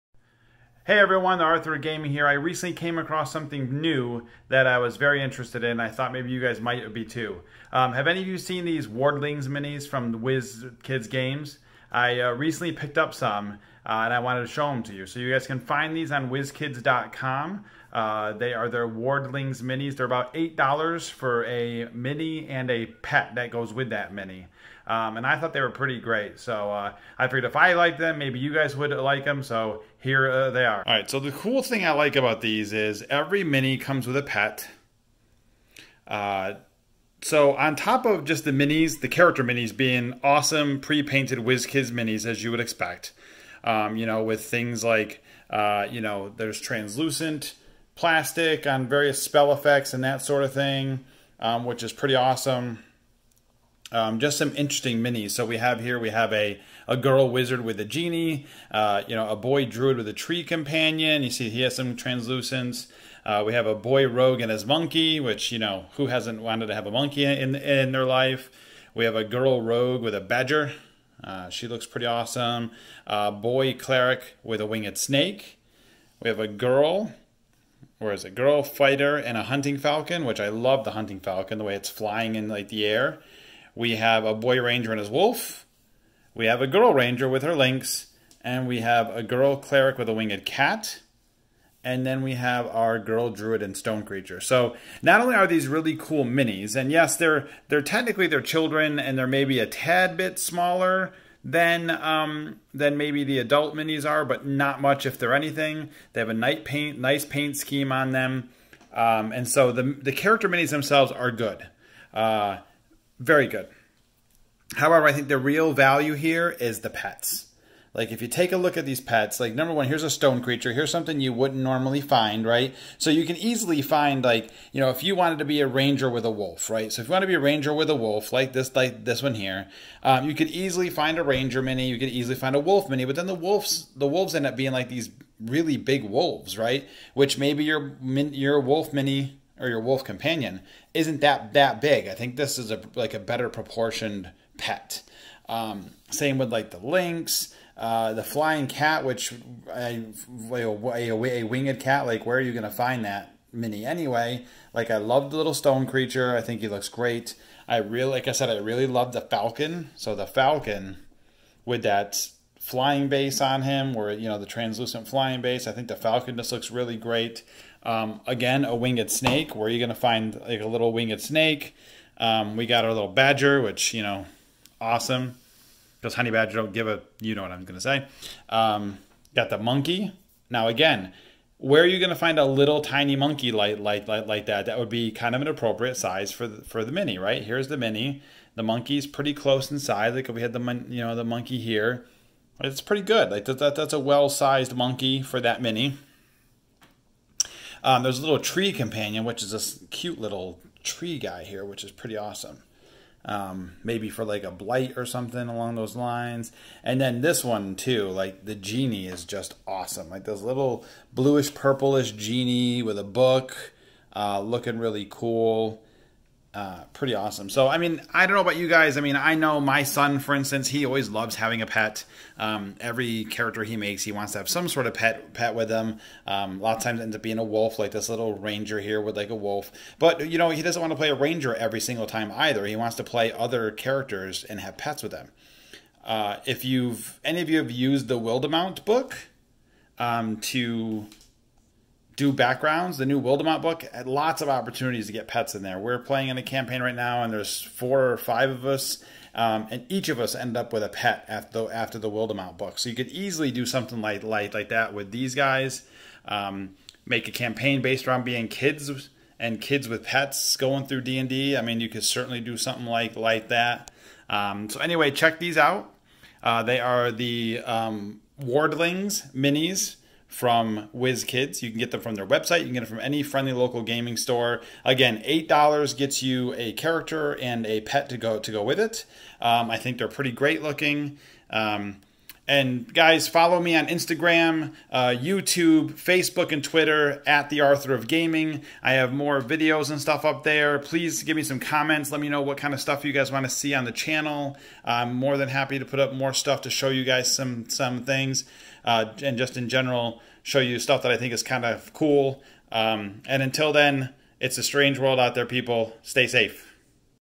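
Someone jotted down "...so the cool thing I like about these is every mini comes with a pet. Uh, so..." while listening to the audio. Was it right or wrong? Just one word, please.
right.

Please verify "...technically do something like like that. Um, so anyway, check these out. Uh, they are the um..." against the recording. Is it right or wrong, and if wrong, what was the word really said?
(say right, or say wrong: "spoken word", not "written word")
wrong: "certainly", not "technically".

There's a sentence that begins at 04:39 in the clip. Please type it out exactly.
Um, I think they're pretty great looking.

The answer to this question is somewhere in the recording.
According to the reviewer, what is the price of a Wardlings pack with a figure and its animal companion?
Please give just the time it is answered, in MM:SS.
00:20.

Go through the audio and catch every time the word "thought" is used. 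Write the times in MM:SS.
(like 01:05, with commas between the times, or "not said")
00:05, 00:25.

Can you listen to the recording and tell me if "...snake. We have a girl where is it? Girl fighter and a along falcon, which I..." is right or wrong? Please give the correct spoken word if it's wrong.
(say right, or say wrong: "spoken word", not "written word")
wrong: "hunting", not "along".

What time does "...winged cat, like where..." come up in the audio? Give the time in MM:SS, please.
02:31.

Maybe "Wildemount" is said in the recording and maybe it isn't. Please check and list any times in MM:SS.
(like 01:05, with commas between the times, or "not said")
03:58, 04:03, 04:12.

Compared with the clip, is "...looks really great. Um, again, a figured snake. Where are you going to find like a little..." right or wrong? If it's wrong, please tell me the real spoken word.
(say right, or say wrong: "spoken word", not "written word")
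wrong: "winged", not "figured".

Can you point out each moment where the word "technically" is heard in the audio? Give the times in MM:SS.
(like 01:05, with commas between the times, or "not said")
01:37.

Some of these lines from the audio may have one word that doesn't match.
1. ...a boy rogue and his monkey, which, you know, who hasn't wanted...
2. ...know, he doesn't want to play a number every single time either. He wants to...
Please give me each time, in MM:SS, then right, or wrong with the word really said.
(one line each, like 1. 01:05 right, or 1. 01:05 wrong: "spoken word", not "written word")
1. 01:03 right
2. 03:50 wrong: "ranger", not "number".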